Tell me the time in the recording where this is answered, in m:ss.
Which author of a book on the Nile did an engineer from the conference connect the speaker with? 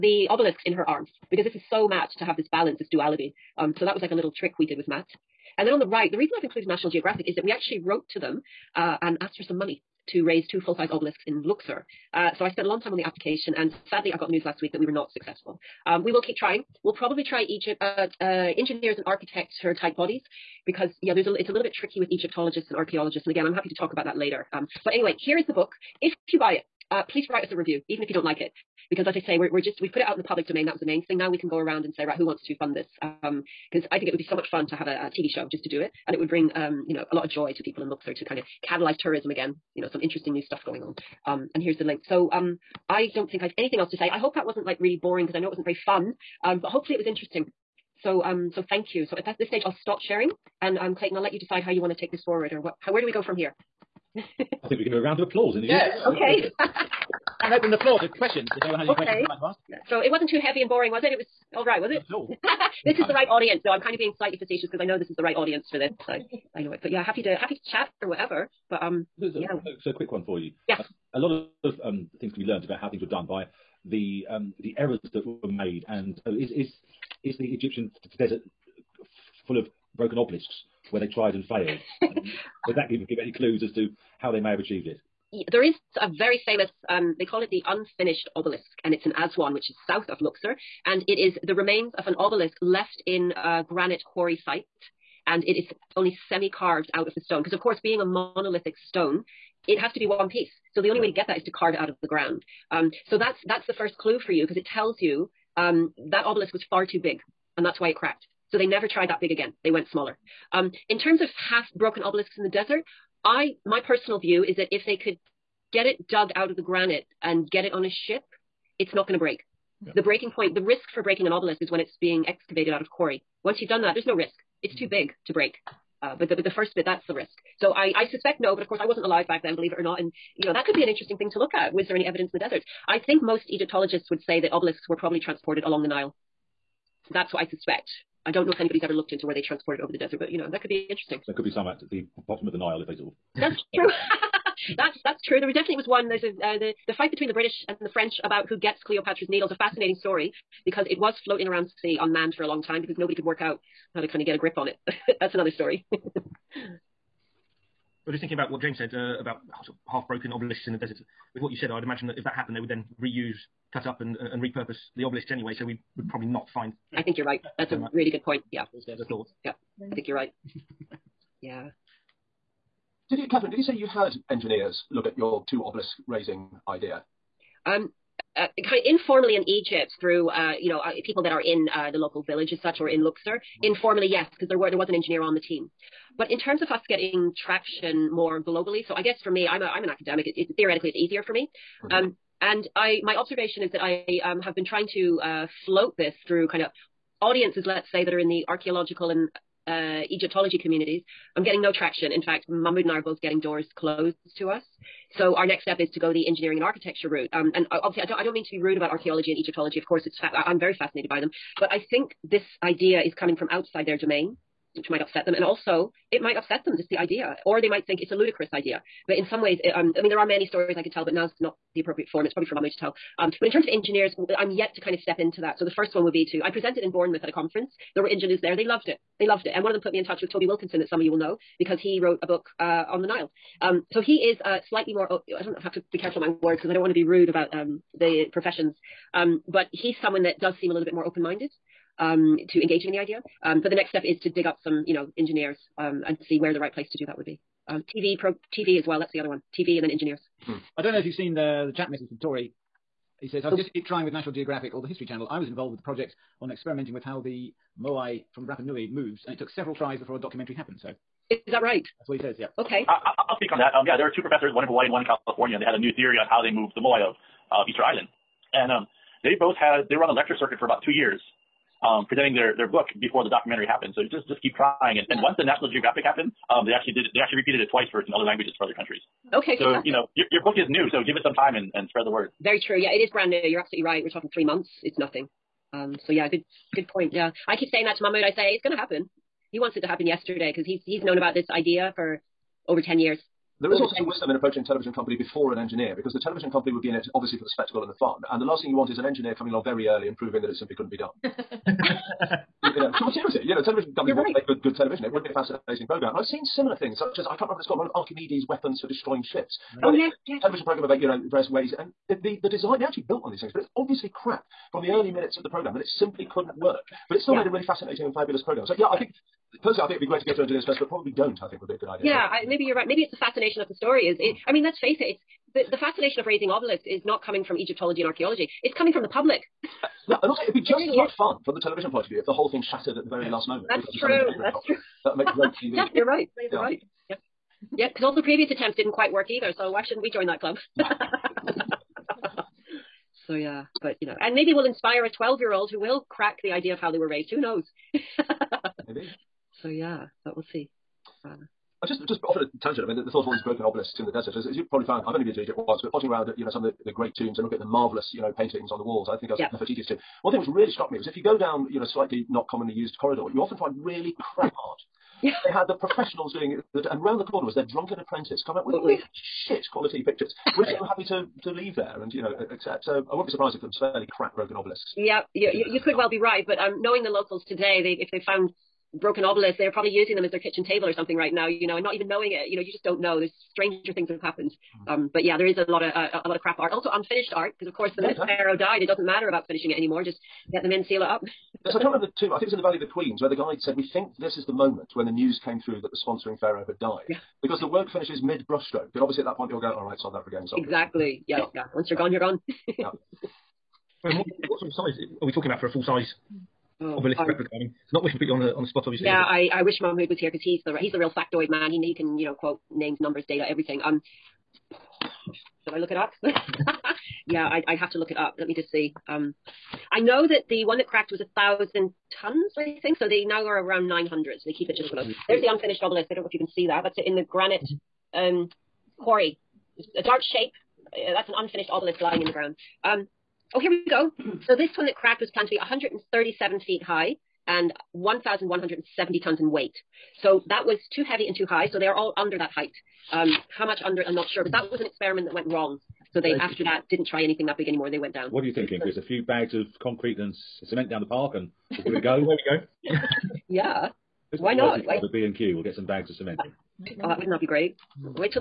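3:50.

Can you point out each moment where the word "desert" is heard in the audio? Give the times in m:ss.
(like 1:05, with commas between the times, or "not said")
1:18, 1:52, 2:12, 2:19, 2:40, 5:54.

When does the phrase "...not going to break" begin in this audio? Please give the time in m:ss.
1:58.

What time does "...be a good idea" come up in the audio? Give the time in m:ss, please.
5:21.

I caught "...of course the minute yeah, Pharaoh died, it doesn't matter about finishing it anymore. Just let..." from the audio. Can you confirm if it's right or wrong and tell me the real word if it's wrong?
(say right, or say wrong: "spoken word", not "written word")
right.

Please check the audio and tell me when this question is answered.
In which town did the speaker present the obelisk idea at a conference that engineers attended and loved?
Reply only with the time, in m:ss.
3:46.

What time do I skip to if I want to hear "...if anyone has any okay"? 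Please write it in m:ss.
0:58.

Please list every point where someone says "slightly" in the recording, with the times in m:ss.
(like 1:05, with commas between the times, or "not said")
1:04, 3:54, 6:01.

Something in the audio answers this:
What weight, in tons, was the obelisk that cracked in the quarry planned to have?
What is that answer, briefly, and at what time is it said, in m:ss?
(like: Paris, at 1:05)
1,170 tons, at 7:17.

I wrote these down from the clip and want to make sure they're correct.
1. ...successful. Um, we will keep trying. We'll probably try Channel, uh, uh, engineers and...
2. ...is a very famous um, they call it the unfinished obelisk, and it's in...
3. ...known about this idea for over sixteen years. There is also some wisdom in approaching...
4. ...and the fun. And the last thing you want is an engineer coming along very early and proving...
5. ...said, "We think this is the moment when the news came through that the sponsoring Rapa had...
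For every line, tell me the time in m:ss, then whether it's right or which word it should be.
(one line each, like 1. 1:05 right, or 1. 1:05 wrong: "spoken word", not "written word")
1. 0:15 wrong: "Egypt", not "Channel"
2. 1:25 right
3. 4:51 wrong: "ten", not "sixteen"
4. 4:57 right
5. 6:33 wrong: "Pharaoh", not "Rapa".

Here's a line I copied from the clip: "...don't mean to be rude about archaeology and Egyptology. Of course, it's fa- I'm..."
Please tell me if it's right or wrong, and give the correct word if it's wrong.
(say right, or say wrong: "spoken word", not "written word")
right.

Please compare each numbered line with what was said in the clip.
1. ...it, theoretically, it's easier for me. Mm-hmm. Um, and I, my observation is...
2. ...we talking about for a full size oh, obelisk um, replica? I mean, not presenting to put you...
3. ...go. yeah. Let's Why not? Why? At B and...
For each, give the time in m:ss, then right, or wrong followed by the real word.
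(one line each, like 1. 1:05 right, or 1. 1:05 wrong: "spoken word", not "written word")
1. 3:10 right
2. 6:45 wrong: "wishing", not "presenting"
3. 7:32 right.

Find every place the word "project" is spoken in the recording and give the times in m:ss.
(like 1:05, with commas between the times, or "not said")
4:15.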